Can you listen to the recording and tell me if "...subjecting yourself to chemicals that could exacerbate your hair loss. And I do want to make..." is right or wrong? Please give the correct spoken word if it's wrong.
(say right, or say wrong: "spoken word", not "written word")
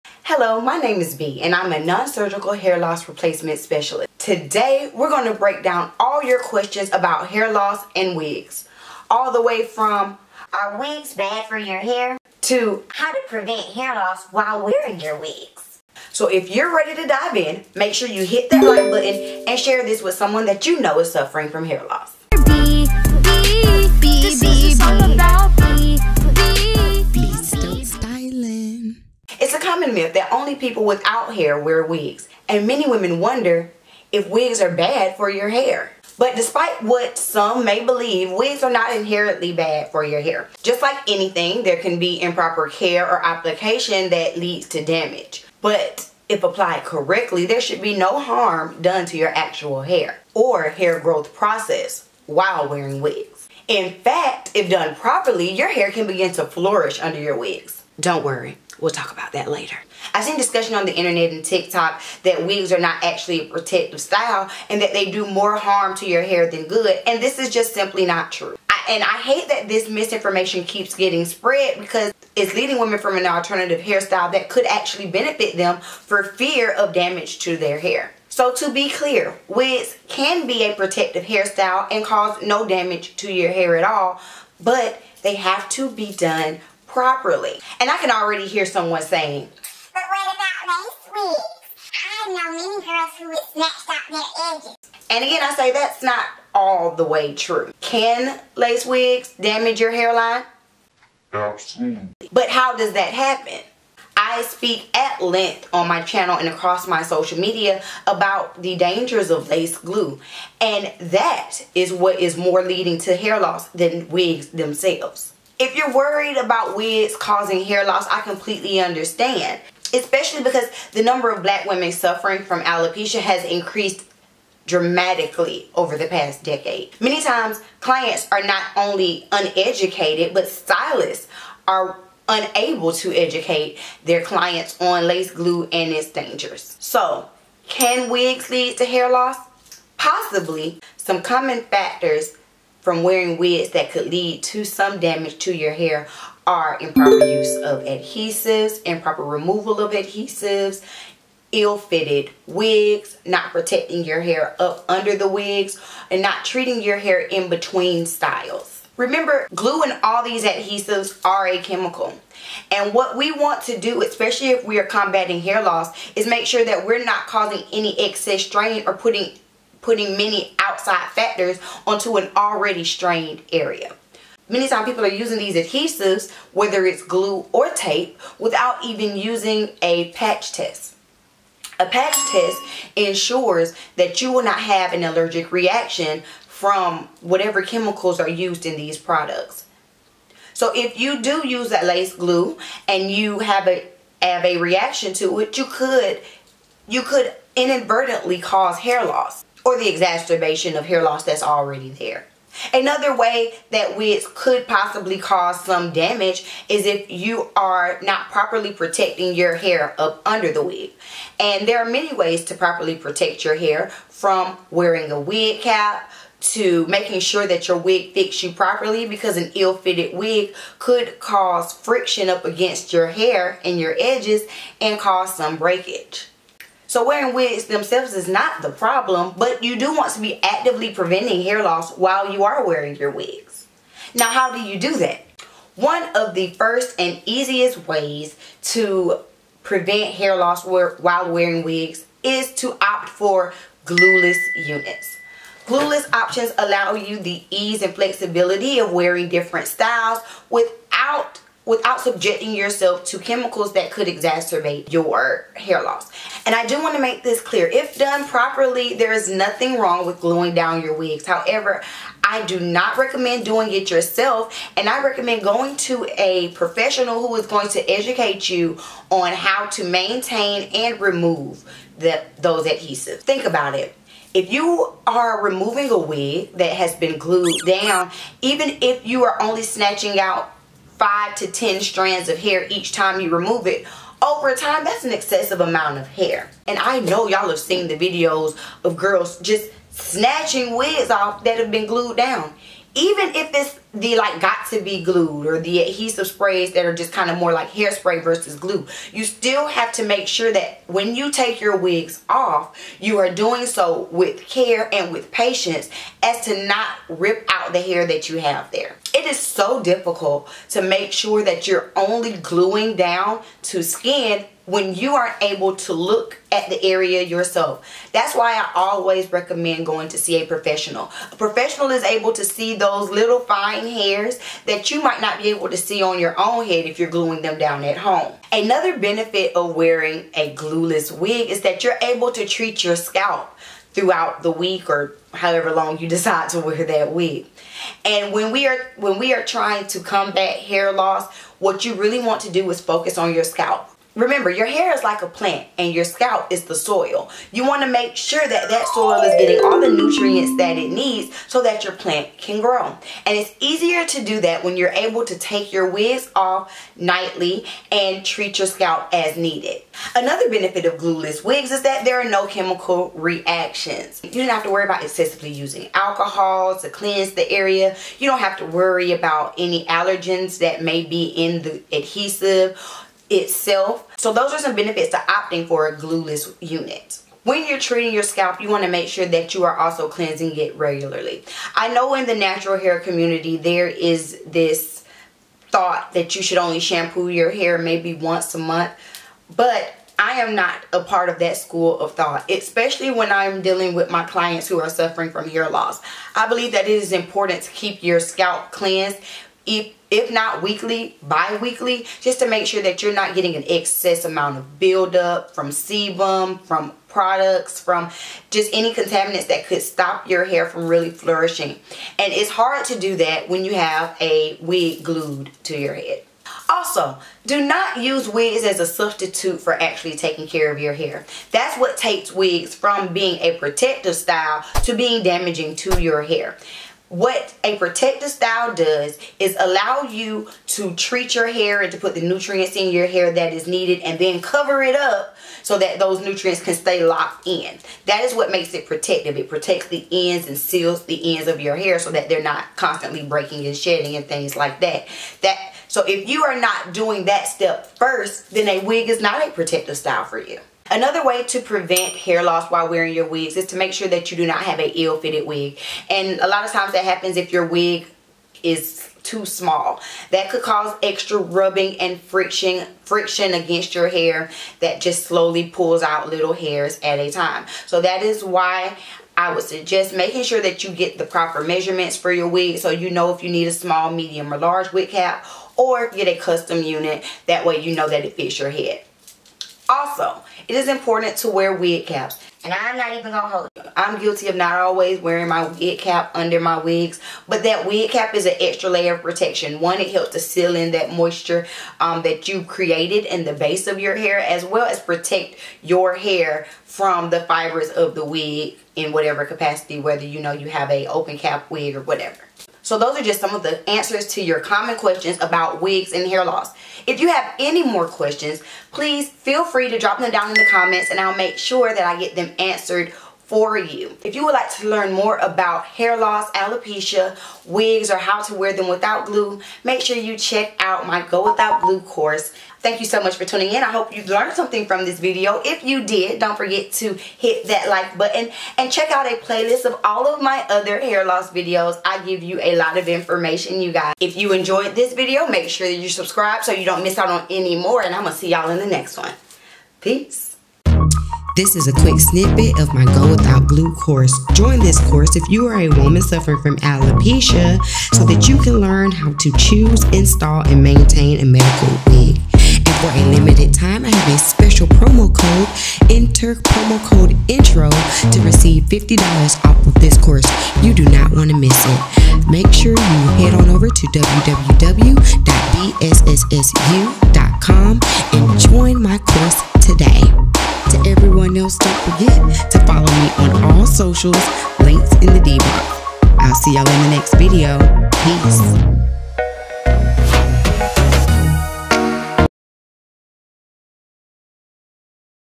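right.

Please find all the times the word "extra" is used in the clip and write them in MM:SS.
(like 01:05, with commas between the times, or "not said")
07:41, 08:08.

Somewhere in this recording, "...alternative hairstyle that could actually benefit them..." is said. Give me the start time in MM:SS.
01:13.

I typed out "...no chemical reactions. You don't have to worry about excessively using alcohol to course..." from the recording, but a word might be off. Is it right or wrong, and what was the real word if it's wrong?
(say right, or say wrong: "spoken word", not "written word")
wrong: "cleanse", not "course".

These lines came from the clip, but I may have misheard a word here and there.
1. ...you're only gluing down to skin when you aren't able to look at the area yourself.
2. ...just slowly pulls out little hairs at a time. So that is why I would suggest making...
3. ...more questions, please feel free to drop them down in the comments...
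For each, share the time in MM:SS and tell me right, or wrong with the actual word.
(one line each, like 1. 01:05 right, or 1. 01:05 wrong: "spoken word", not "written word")
1. 05:11 right
2. 07:44 right
3. 08:27 right.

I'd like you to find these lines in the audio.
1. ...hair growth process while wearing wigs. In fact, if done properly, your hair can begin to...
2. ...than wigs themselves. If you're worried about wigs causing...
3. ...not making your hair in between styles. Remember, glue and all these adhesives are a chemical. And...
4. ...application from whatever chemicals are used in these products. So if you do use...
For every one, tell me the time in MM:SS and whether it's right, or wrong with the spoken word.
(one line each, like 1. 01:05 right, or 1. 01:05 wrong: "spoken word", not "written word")
1. 00:50 right
2. 01:53 right
3. 02:36 wrong: "treating", not "making"
4. 03:05 wrong: "reaction", not "application".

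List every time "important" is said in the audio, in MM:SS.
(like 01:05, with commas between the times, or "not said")
06:37, 08:00.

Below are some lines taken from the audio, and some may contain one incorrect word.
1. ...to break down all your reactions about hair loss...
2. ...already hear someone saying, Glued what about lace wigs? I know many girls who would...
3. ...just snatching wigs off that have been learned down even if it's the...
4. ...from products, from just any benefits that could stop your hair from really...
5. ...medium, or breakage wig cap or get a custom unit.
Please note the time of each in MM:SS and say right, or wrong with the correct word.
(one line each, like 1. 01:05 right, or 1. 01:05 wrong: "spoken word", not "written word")
1. 00:05 wrong: "questions", not "reactions"
2. 01:28 wrong: "But", not "Glued"
3. 04:49 wrong: "glued", not "learned"
4. 06:46 wrong: "contaminants", not "benefits"
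5. 07:54 wrong: "large", not "breakage".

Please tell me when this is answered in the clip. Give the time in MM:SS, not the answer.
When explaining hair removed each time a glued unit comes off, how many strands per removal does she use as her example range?
04:41.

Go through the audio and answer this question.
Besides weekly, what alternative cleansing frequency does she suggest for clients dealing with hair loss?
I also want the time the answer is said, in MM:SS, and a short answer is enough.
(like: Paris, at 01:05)
Bi-weekly, at 06:41.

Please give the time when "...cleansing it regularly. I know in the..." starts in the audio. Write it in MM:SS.
06:20.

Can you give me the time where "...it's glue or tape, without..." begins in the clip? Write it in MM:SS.
02:56.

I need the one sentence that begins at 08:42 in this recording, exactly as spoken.
Thank you so much for tuning in.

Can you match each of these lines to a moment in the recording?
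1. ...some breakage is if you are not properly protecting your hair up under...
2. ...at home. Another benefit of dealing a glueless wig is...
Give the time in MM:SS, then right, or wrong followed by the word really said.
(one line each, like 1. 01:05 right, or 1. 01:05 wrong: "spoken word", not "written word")
1. 03:25 wrong: "damage", not "breakage"
2. 05:27 wrong: "wearing", not "dealing".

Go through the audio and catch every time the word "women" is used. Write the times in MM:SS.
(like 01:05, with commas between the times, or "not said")
00:32, 01:12, 02:01.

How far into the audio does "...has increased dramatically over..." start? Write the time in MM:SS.
02:03.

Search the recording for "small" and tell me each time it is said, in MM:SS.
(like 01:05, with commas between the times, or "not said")
07:39, 07:53.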